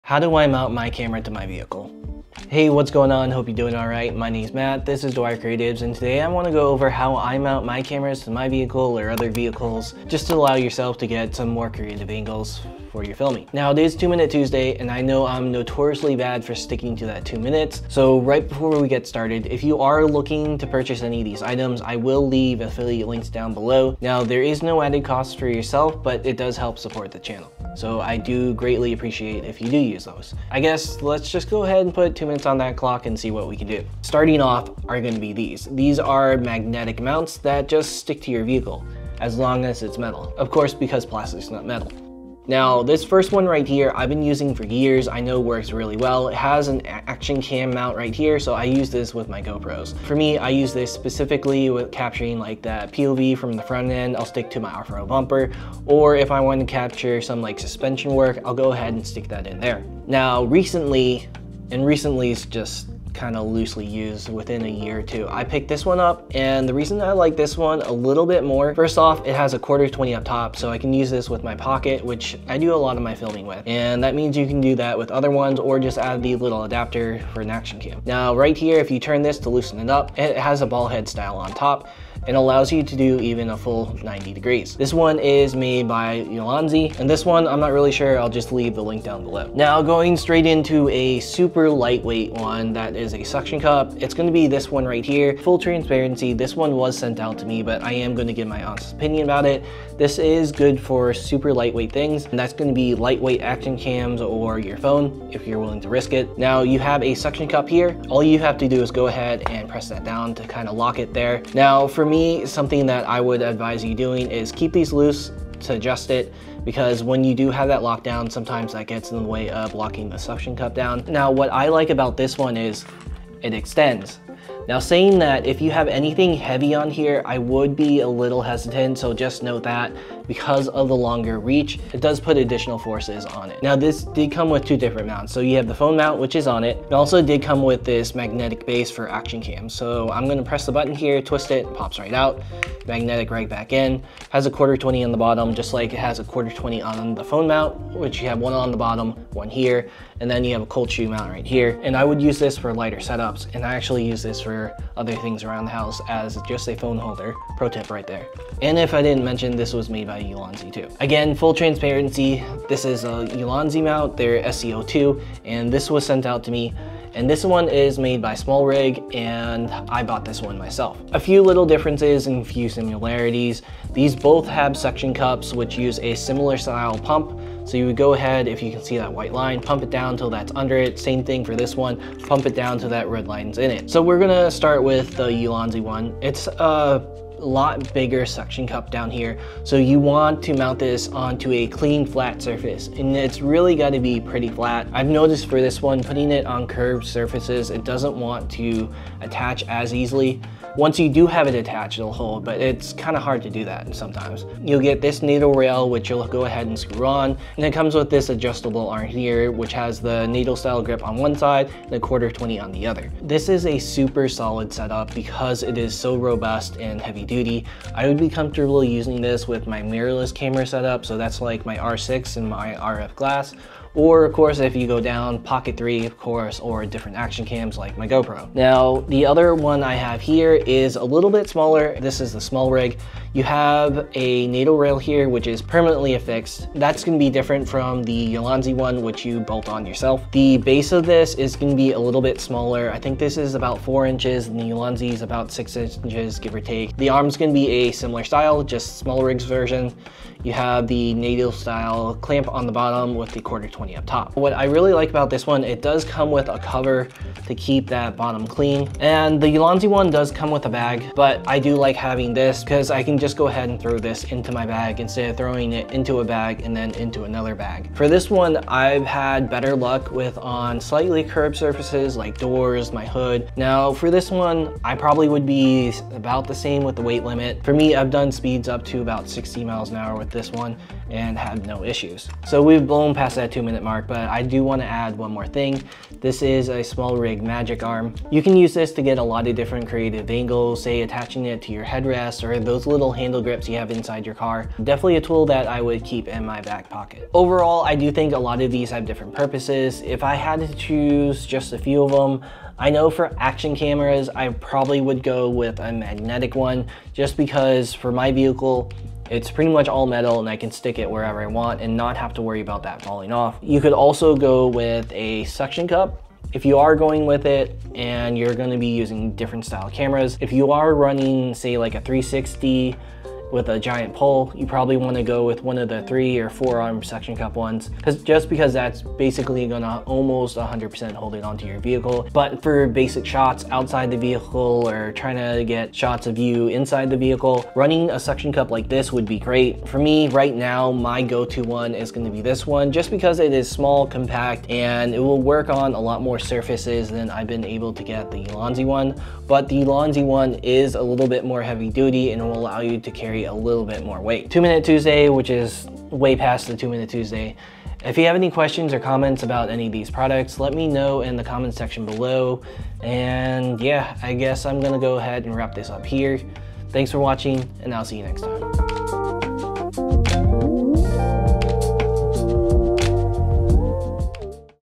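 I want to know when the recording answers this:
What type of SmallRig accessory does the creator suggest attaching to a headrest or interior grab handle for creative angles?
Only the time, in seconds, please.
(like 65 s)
287 s.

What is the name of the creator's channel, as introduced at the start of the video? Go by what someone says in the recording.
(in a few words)
Dwyer Creatives.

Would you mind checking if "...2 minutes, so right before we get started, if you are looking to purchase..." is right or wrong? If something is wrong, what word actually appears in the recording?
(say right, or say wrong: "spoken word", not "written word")
right.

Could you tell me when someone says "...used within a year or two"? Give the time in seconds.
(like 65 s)
63 s.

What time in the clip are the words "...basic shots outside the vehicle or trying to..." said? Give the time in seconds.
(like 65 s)
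332 s.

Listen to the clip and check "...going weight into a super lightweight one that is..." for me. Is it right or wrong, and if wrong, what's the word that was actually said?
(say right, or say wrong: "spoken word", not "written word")
wrong: "straight", not "weight".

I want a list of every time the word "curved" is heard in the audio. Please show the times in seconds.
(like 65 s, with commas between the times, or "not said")
196 s, 271 s.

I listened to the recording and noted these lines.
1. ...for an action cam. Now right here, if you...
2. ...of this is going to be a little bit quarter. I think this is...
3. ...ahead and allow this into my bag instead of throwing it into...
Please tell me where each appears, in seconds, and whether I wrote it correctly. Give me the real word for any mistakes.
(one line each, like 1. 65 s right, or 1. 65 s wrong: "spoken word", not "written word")
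1. 77 s right
2. 240 s wrong: "smaller", not "quarter"
3. 263 s wrong: "throw", not "allow".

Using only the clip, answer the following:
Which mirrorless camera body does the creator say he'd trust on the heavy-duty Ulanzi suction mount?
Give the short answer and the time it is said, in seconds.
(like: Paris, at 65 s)
R6, at 221 s.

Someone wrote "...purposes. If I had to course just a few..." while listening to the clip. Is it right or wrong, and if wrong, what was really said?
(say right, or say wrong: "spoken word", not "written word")
wrong: "choose", not "course".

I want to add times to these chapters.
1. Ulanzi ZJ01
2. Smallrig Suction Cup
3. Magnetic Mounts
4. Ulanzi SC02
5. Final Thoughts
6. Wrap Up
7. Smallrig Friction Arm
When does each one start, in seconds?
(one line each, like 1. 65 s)
1. 89 s
2. 229 s
3. 34 s
4. 161 s
5. 297 s
6. 354 s
7. 282 s.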